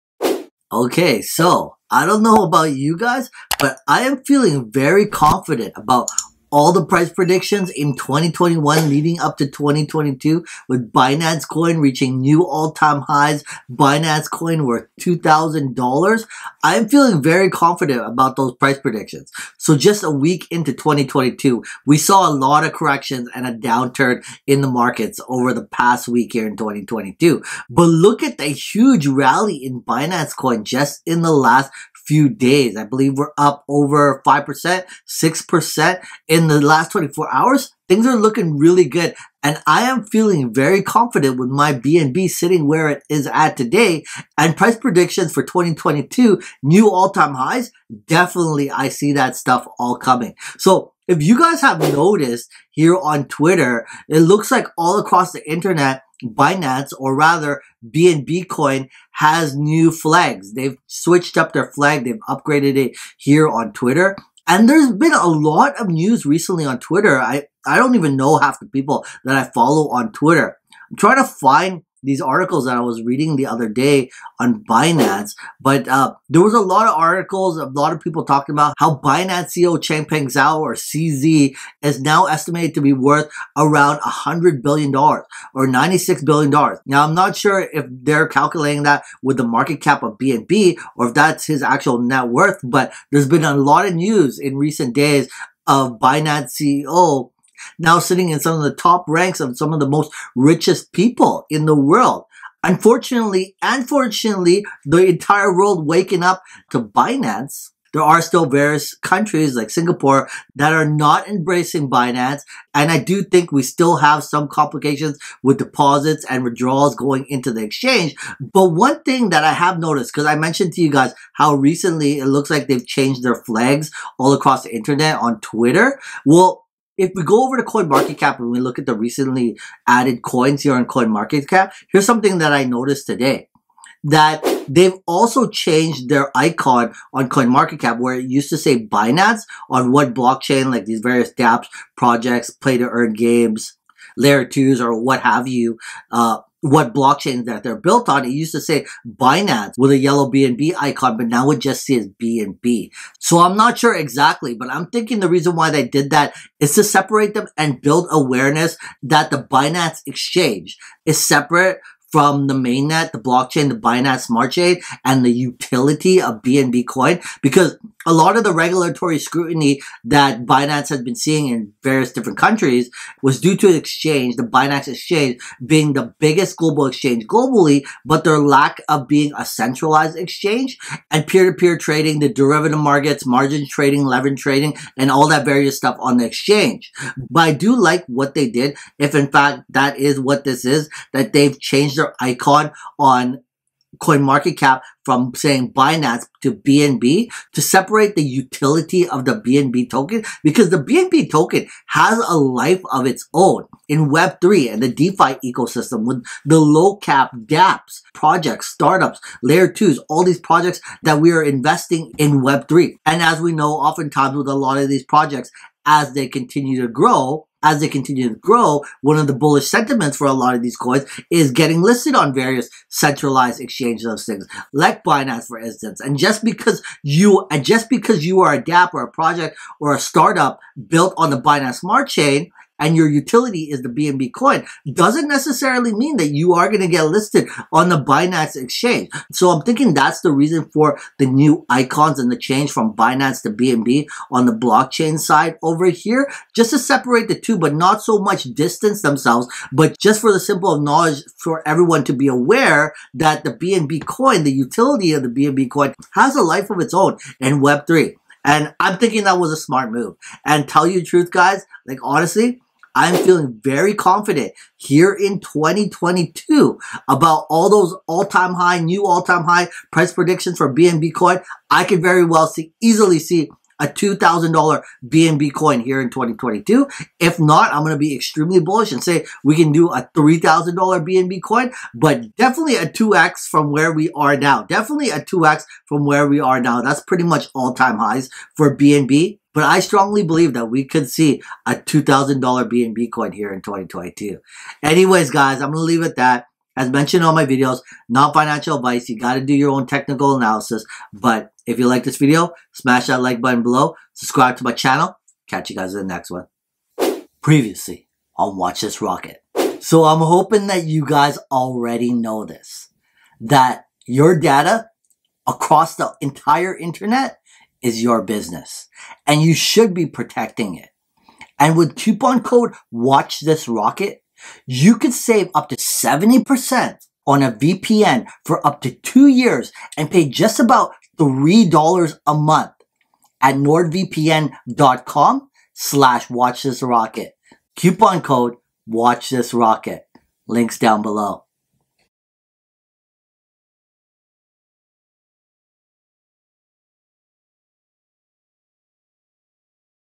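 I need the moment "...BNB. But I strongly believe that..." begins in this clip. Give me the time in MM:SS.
04:48.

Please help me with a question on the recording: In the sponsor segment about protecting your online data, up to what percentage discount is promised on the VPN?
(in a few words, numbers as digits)
70%.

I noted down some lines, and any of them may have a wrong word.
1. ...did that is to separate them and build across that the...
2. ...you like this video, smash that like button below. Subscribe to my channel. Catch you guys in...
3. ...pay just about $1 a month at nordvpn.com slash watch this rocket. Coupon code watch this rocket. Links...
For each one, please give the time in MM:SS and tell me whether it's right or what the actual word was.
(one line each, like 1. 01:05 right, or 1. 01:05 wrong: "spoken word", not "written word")
1. 02:35 wrong: "awareness", not "across"
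2. 05:01 right
3. 05:30 wrong: "3", not "1".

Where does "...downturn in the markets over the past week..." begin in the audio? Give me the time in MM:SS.
00:23.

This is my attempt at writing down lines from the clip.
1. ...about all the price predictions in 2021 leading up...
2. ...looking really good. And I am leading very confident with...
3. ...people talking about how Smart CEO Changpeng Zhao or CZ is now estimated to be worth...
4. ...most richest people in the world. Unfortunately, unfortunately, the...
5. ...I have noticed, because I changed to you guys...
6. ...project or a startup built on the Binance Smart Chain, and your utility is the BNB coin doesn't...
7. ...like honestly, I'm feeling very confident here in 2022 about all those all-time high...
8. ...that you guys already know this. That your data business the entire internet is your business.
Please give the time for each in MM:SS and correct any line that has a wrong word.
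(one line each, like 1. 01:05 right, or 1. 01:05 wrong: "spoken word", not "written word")
1. 00:05 right
2. 00:38 wrong: "feeling", not "leading"
3. 01:18 wrong: "Binance", not "Smart"
4. 01:39 right
5. 01:59 wrong: "mentioned", not "changed"
6. 03:49 right
7. 04:21 right
8. 05:10 wrong: "across", not "business".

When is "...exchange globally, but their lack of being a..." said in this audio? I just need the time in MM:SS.
02:56.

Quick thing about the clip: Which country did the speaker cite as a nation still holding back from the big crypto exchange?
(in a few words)
Singapore.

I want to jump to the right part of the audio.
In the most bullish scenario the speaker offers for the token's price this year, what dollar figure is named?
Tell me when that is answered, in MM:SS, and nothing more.
04:40.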